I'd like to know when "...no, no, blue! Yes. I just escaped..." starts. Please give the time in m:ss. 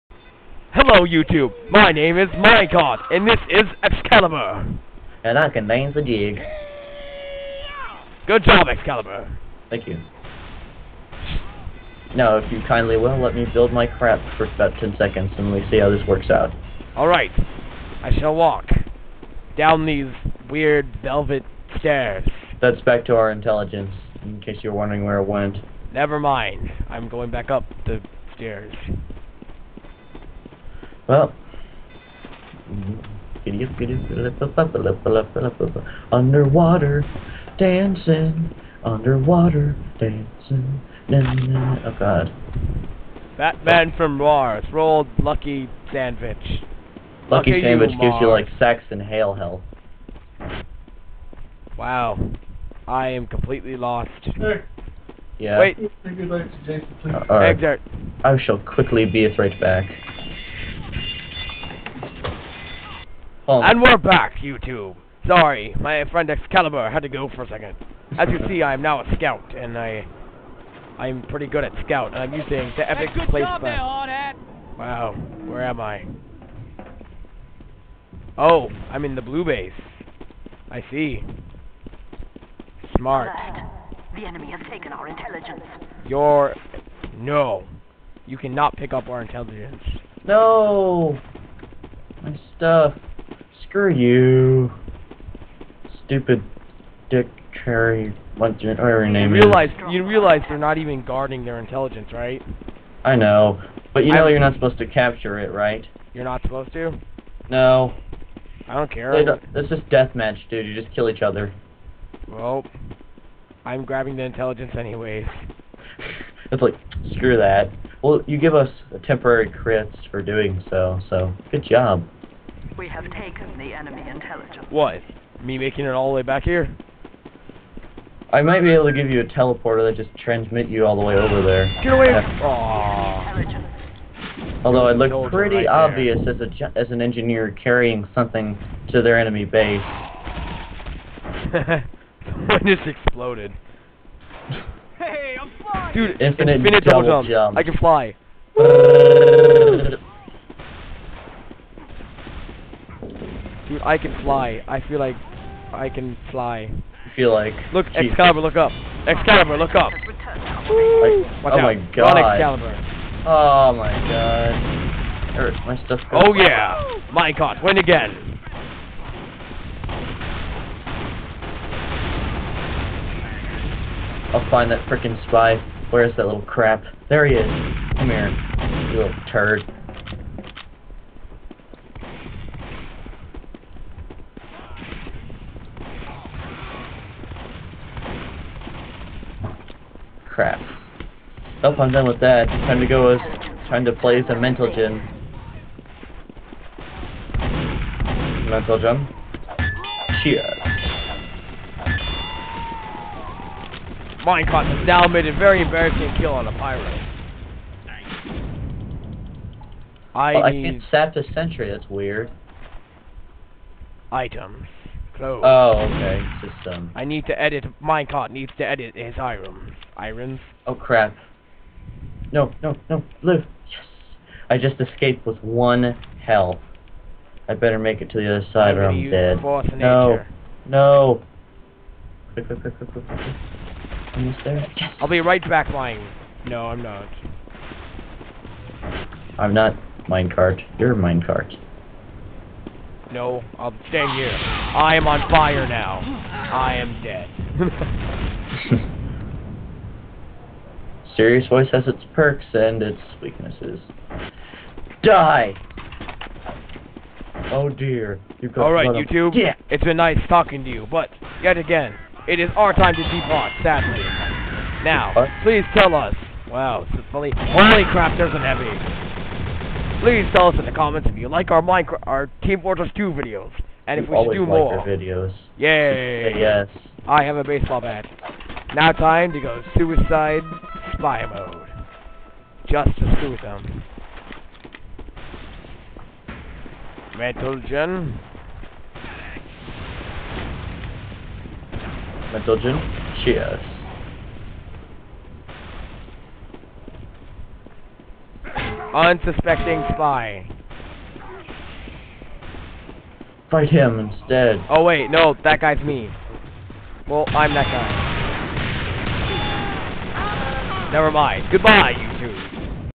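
3:42.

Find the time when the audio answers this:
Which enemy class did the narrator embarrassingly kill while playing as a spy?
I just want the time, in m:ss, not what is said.
3:26.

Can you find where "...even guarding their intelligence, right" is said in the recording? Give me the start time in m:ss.
1:40.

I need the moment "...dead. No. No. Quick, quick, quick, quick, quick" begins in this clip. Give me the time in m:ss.
3:49.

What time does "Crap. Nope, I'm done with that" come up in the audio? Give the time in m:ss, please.
3:10.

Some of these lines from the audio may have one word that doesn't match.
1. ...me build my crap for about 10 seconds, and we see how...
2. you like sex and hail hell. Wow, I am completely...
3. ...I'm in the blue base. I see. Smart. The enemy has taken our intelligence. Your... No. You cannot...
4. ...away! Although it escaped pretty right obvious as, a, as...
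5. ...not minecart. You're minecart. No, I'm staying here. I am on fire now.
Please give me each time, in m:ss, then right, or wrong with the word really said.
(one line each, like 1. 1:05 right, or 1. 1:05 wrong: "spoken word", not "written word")
1. 0:13 right
2. 0:48 right
3. 1:18 right
4. 2:11 wrong: "looked", not "escaped"
5. 3:59 right.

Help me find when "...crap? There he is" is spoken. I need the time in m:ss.
2:56.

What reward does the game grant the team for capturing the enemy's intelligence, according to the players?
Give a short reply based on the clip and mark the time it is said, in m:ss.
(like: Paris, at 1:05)
temporary crits, at 1:59.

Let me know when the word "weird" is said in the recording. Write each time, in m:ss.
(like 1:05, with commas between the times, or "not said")
0:20, 3:31.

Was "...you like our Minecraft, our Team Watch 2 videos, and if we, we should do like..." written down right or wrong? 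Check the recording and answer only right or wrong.
wrong.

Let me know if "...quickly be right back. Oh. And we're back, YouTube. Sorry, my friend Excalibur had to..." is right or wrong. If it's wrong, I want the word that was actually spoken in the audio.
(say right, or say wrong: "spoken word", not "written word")
right.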